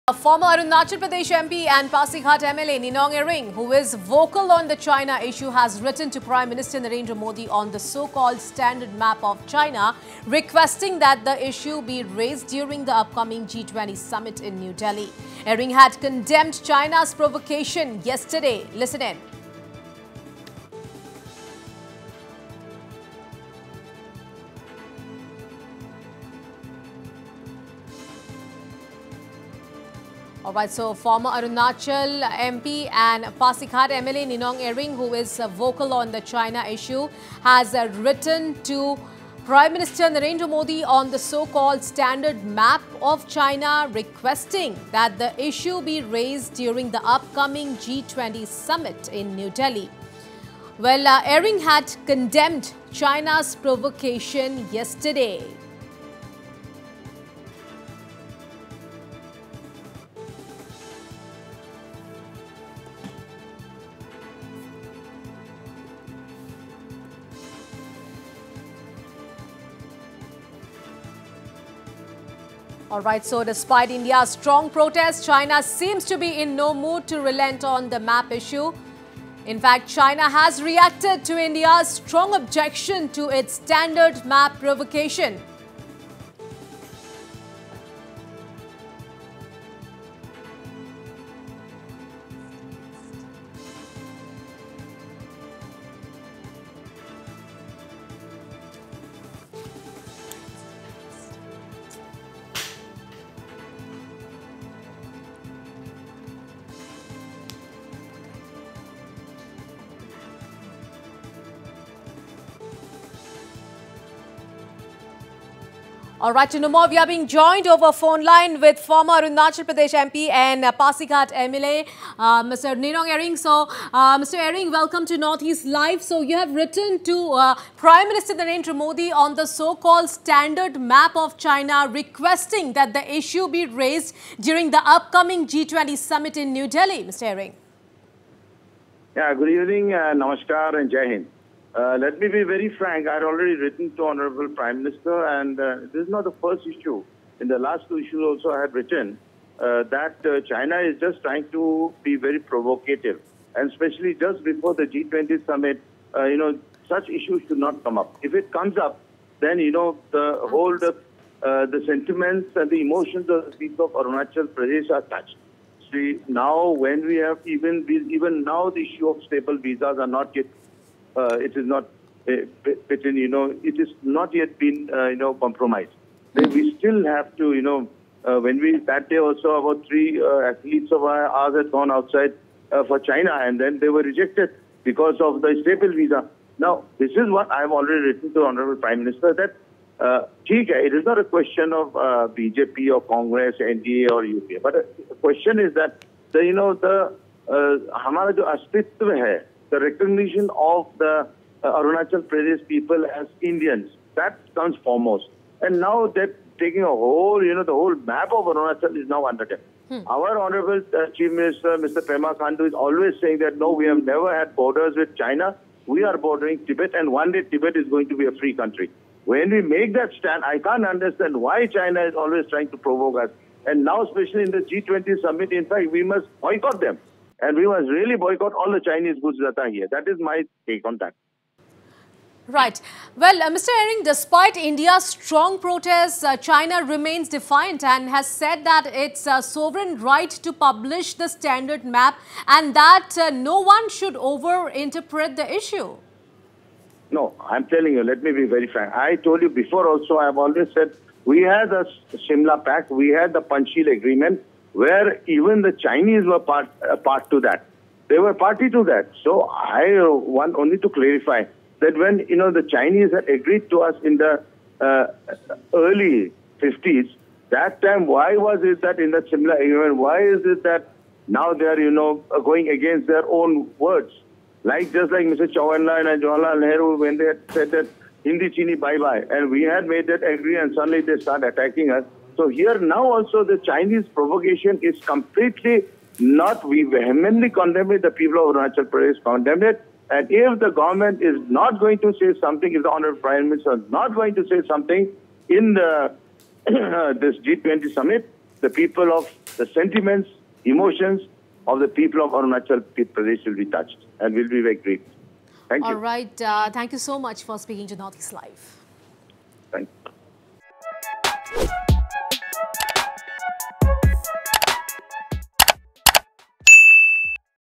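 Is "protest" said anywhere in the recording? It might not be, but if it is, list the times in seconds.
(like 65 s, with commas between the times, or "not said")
74 s, 235 s.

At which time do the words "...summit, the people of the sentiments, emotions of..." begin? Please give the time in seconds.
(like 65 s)
297 s.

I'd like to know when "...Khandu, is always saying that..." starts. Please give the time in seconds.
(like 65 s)
212 s.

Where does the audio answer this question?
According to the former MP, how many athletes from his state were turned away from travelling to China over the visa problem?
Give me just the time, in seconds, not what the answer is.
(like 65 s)
179 s.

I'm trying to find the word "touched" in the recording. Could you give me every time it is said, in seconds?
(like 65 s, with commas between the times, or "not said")
165 s, 303 s.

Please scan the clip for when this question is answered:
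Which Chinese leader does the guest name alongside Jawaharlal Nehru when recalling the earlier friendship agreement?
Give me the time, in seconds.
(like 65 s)
275 s.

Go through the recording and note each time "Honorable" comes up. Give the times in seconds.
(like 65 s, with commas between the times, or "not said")
144 s, 188 s, 210 s, 292 s.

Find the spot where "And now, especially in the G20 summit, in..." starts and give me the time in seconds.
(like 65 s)
223 s.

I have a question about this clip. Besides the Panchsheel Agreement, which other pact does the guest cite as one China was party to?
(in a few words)
Shimla Pact.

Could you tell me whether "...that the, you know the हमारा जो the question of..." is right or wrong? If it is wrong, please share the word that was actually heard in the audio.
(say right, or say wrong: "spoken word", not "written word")
wrong: "recognition", not "question".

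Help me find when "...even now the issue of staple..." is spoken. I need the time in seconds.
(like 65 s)
168 s.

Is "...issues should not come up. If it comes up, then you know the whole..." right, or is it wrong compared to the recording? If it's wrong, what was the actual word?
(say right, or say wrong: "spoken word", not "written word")
right.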